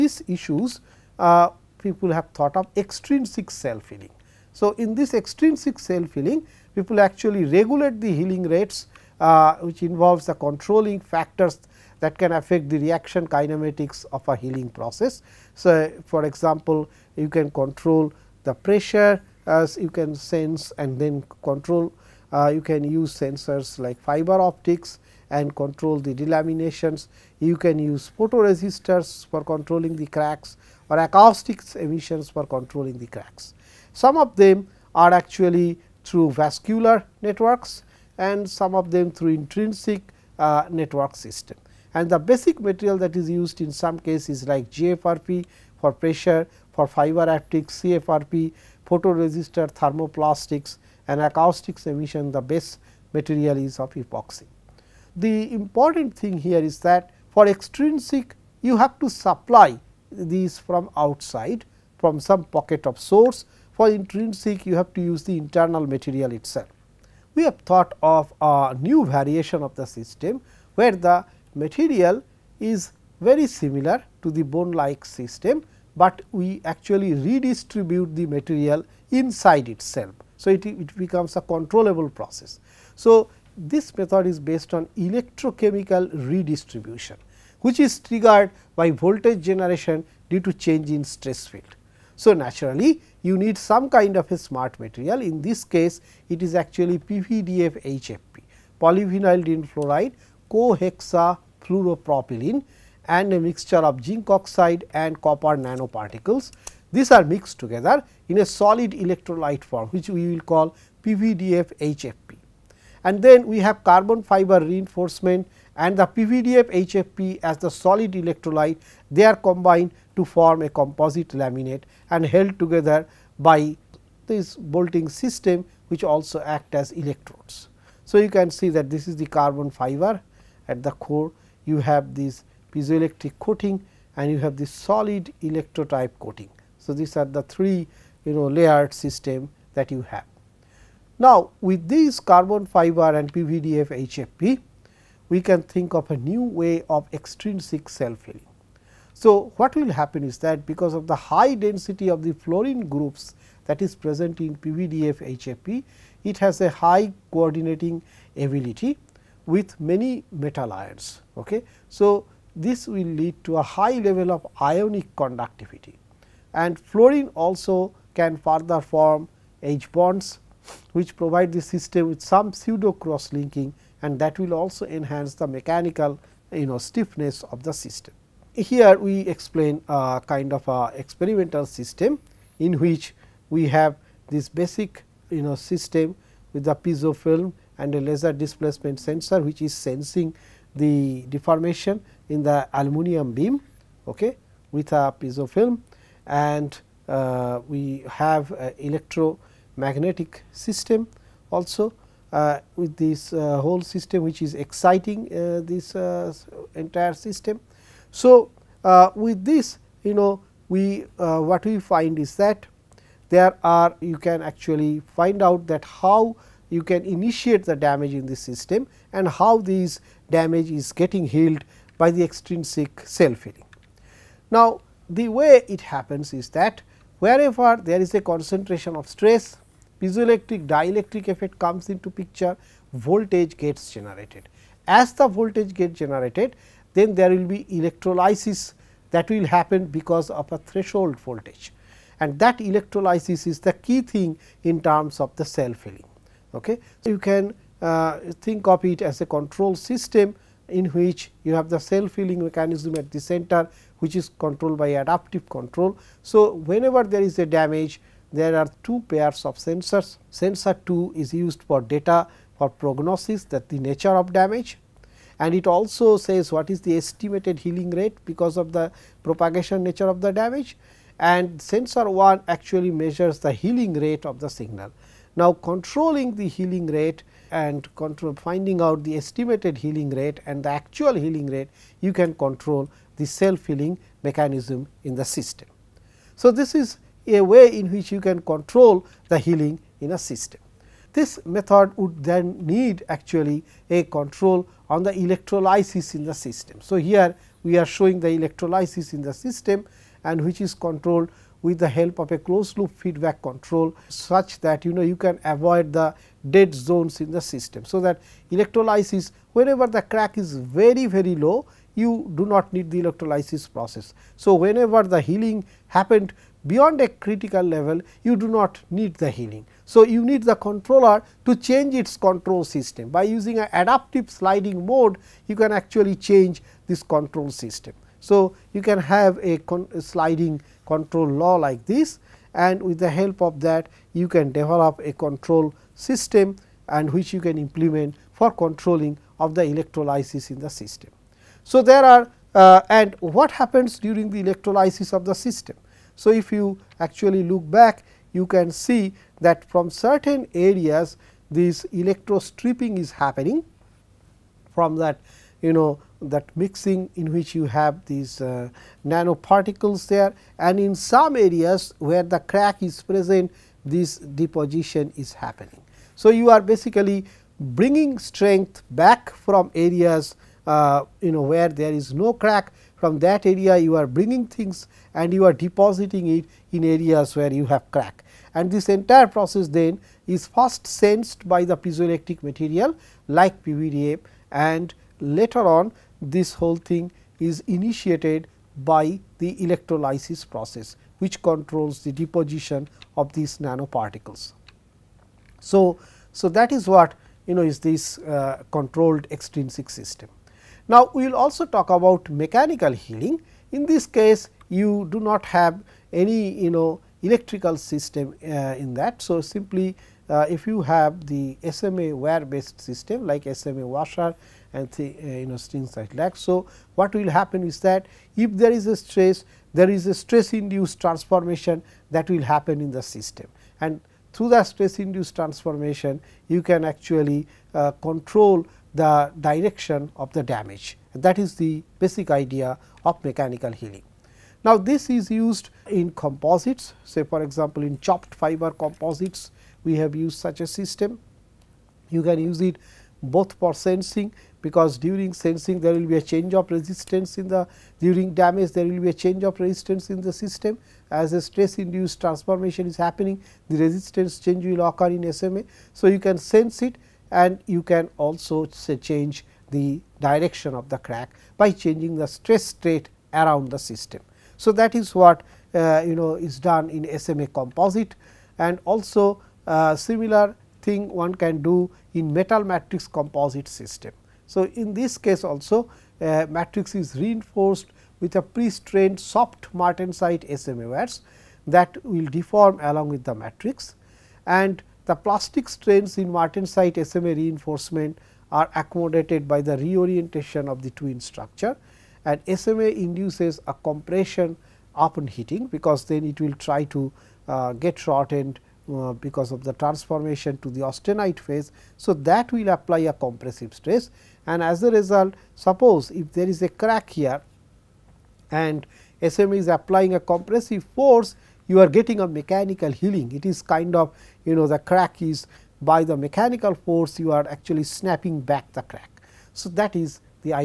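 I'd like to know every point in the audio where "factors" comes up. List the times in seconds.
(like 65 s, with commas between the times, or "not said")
10 s.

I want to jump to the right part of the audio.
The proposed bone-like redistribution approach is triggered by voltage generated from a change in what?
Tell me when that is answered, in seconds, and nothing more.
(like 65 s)
91 s.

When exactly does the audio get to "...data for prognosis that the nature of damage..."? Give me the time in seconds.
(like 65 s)
261 s.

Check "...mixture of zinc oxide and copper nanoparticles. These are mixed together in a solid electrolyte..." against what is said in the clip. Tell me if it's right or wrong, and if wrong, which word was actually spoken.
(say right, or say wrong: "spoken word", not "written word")
right.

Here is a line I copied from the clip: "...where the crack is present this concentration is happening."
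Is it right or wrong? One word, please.
wrong.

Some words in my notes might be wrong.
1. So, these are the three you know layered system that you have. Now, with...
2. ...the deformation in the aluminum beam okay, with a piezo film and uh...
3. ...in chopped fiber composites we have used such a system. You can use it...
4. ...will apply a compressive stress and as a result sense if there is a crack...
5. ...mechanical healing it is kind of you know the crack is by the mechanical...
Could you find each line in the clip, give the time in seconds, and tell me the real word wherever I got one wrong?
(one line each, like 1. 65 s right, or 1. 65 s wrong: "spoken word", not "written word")
1. 136 s right
2. 190 s right
3. 437 s right
4. 502 s wrong: "suppose", not "sense"
5. 512 s right.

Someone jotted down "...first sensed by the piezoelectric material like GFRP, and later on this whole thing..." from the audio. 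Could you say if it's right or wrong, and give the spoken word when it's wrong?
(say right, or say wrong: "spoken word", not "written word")
wrong: "PVDA", not "GFRP".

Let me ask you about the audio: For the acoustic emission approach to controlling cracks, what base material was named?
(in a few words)
epoxy.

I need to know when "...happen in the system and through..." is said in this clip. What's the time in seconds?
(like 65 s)
422 s.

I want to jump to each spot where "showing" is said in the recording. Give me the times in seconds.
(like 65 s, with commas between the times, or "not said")
297 s.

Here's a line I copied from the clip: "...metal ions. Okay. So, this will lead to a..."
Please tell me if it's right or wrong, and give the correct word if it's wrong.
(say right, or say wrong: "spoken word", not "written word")
right.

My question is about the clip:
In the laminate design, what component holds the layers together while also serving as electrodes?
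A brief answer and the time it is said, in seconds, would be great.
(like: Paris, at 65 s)
bolting system, at 124 s.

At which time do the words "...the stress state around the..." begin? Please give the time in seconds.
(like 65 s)
462 s.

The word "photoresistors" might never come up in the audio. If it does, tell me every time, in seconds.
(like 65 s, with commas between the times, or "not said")
28 s, 48 s.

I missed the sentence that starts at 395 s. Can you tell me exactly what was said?
So, so that is what you know is this uh, controlled extrinsic system.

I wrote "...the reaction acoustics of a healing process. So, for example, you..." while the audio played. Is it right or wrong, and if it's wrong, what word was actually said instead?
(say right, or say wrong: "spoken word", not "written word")
wrong: "kinematics", not "acoustics".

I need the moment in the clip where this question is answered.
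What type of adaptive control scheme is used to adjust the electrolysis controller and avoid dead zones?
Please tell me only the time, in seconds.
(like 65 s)
323 s.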